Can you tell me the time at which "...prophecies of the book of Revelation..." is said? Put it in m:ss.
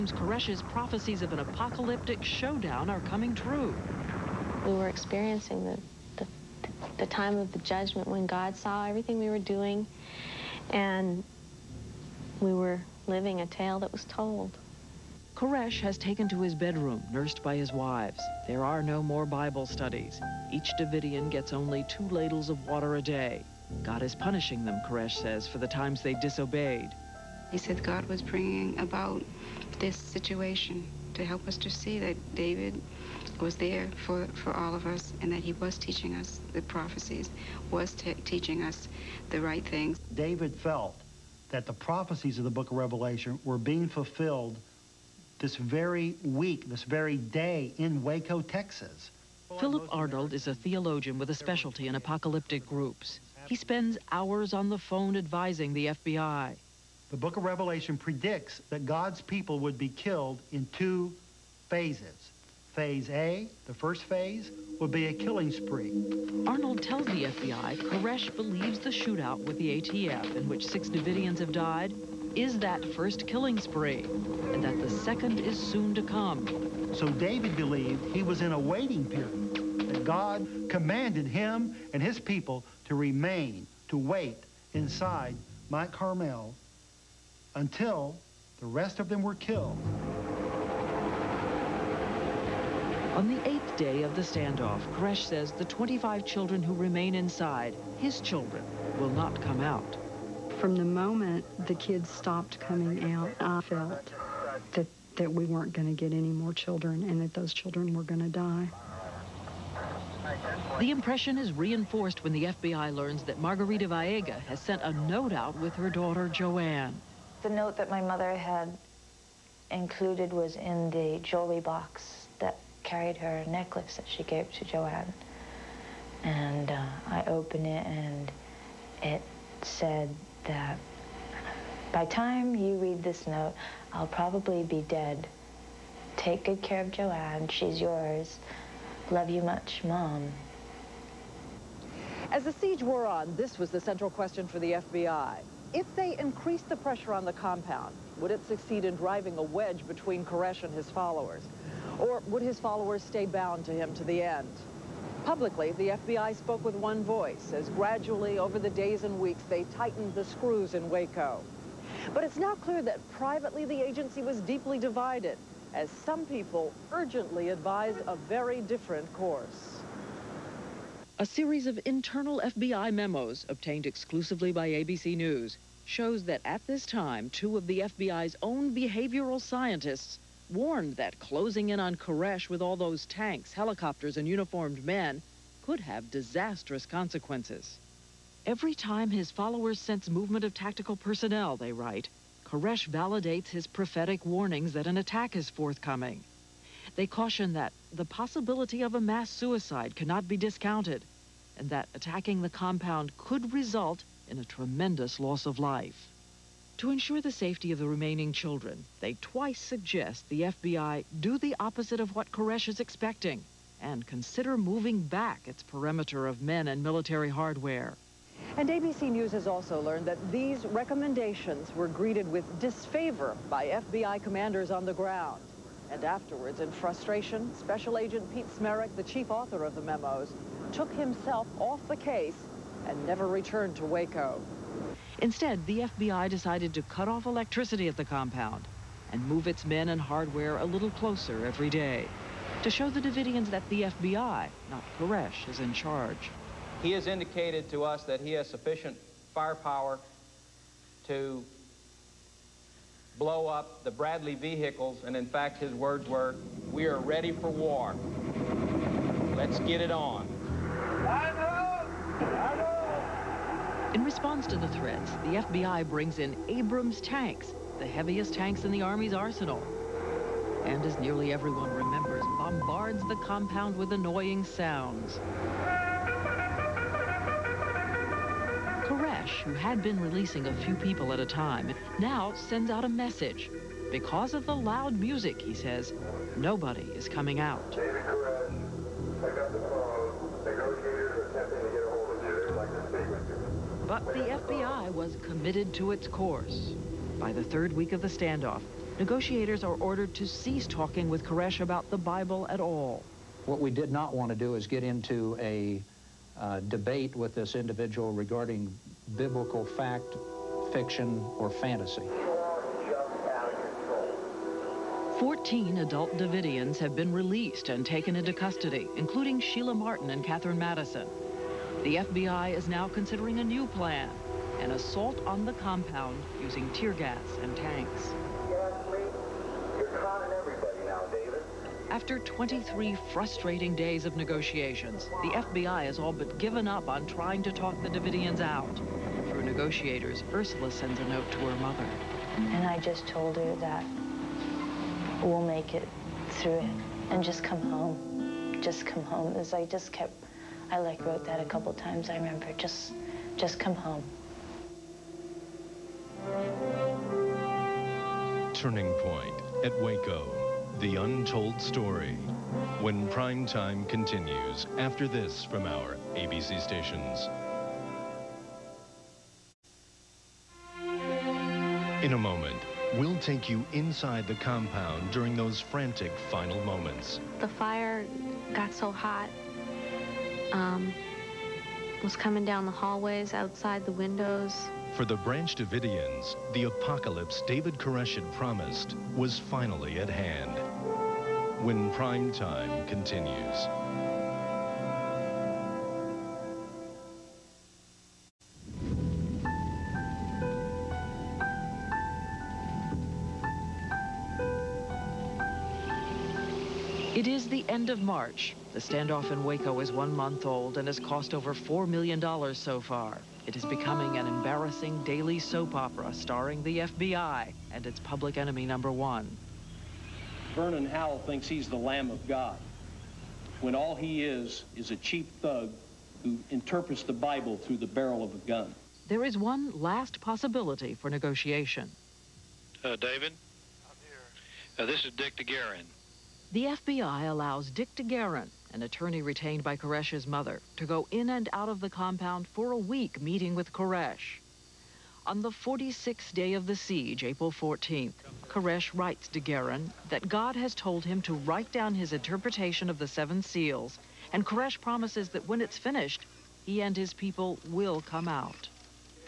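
0:41.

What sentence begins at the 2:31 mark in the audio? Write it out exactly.
Or would his followers stay bound to him to the end?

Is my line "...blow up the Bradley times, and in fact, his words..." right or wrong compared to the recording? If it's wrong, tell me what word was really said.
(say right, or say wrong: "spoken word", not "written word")
wrong: "vehicles", not "times".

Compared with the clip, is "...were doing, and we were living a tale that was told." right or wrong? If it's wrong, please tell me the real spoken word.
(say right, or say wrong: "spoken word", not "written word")
right.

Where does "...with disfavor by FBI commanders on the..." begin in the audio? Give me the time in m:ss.
3:42.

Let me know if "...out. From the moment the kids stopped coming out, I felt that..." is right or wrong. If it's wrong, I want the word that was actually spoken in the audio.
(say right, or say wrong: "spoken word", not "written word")
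right.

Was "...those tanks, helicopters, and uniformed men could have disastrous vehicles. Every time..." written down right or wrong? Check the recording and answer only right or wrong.
wrong.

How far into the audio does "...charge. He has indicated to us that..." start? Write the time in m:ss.
4:05.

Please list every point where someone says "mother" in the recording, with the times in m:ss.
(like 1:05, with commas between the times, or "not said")
1:57, 5:41, 7:20.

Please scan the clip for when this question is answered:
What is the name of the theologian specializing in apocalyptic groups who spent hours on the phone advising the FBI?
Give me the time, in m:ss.
0:49.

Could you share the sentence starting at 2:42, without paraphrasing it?
But it's now clear that privately the agency was deeply divided as some people urgently advised a very different course.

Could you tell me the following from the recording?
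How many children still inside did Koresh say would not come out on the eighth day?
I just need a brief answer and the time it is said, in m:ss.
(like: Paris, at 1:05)
25, at 1:35.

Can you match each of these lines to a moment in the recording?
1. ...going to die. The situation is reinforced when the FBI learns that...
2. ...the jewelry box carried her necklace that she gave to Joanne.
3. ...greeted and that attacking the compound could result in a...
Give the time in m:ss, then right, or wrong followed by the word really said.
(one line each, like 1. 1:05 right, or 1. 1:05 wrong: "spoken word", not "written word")
1. 1:48 wrong: "impression", not "situation"
2. 2:00 right
3. 3:20 wrong: "discounted", not "greeted".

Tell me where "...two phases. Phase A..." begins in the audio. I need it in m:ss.
1:00.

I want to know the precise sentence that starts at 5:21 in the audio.
The FBI is now considering a new plan, an assault on the compound using tear gas and tanks.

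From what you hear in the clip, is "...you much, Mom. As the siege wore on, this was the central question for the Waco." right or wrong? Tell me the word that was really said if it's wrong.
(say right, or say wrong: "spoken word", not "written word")
wrong: "FBI", not "Waco".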